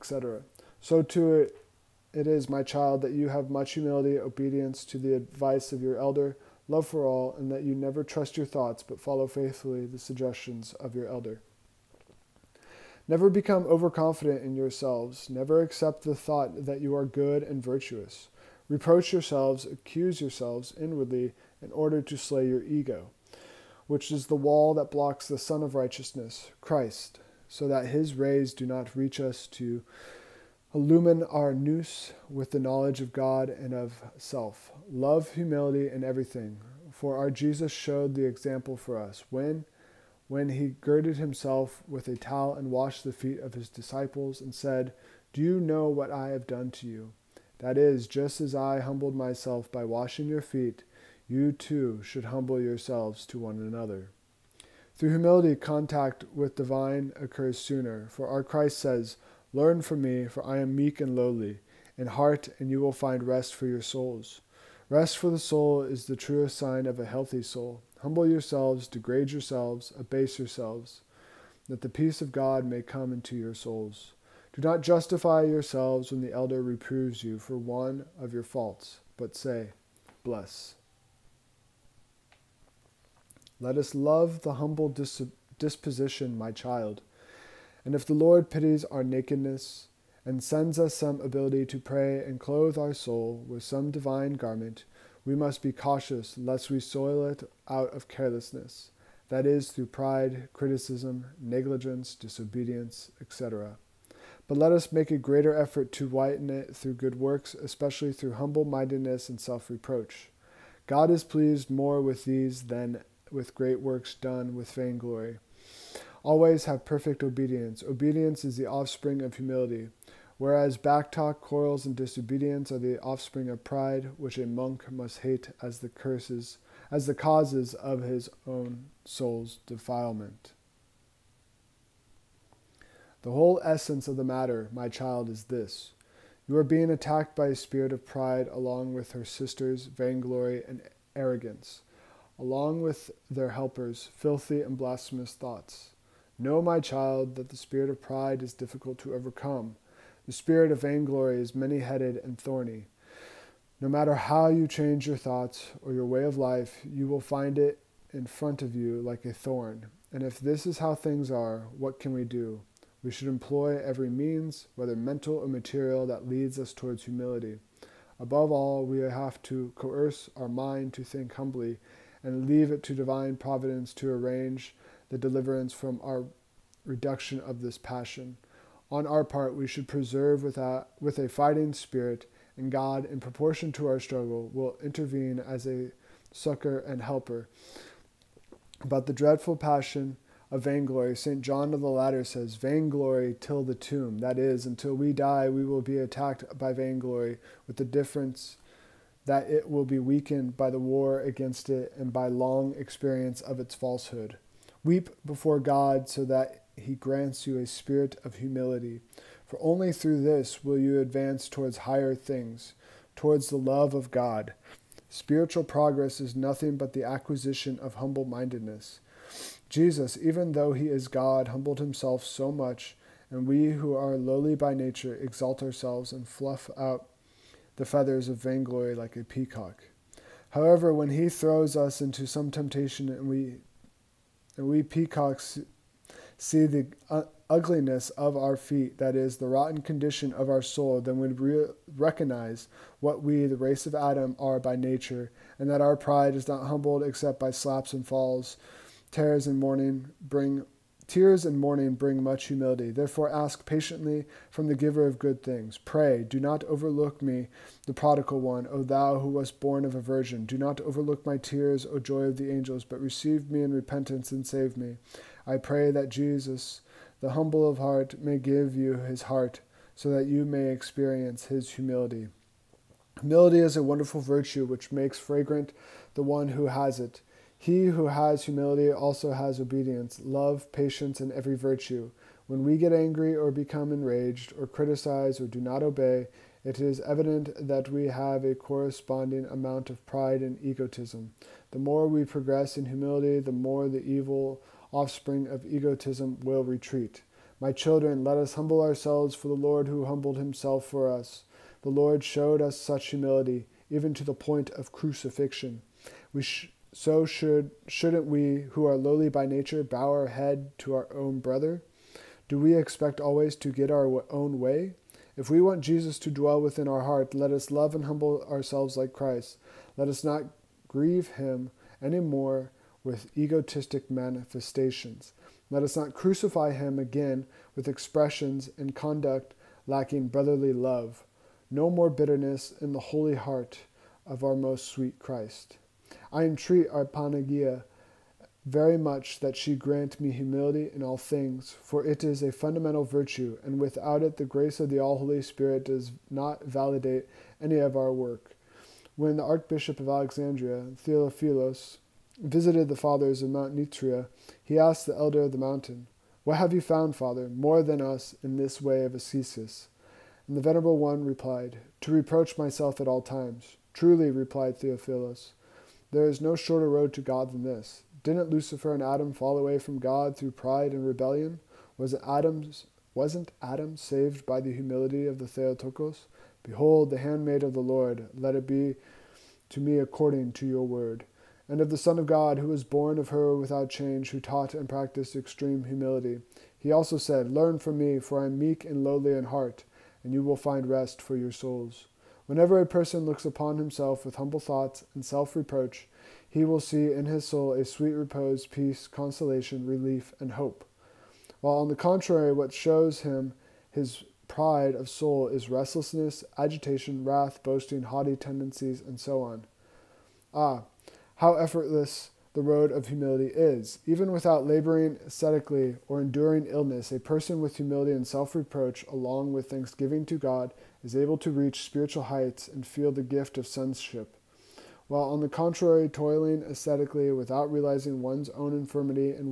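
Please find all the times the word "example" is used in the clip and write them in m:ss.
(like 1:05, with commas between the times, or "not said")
0:38.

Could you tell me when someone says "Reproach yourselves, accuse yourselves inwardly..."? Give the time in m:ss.
0:18.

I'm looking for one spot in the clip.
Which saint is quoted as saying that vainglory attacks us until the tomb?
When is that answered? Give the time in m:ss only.
3:11.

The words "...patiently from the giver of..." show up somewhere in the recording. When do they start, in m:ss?
4:13.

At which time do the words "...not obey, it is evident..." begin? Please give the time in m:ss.
4:45.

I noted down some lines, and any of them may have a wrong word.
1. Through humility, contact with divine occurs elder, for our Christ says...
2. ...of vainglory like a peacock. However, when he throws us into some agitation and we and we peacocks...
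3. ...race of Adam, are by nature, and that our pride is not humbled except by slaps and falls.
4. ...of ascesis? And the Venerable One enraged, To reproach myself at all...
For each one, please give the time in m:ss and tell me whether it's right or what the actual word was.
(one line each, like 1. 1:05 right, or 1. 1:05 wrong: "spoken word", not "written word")
1. 0:54 wrong: "sooner", not "elder"
2. 3:48 wrong: "temptation", not "agitation"
3. 4:03 right
4. 5:59 wrong: "replied", not "enraged".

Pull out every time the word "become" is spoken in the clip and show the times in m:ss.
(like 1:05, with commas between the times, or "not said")
0:13, 4:43.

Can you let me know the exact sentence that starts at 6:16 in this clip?
Behold, the handmaid of the Lord, let it be to me according to your word.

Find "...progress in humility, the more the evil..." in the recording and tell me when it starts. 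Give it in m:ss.
4:52.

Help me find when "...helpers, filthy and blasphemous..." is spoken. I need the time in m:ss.
2:23.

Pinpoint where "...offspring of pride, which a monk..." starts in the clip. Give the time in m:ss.
2:03.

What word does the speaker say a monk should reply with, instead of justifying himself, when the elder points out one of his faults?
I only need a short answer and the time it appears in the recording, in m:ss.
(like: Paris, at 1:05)
Bless, at 1:20.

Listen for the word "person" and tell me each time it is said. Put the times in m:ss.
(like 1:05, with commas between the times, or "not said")
6:32, 6:57.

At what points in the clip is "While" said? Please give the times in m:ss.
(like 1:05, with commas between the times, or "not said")
6:41, 7:05.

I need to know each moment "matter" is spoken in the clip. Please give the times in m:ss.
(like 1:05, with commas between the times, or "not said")
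2:14, 2:33.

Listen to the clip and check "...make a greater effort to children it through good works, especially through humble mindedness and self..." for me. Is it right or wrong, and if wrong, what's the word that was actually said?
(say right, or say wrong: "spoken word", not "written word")
wrong: "whiten", not "children".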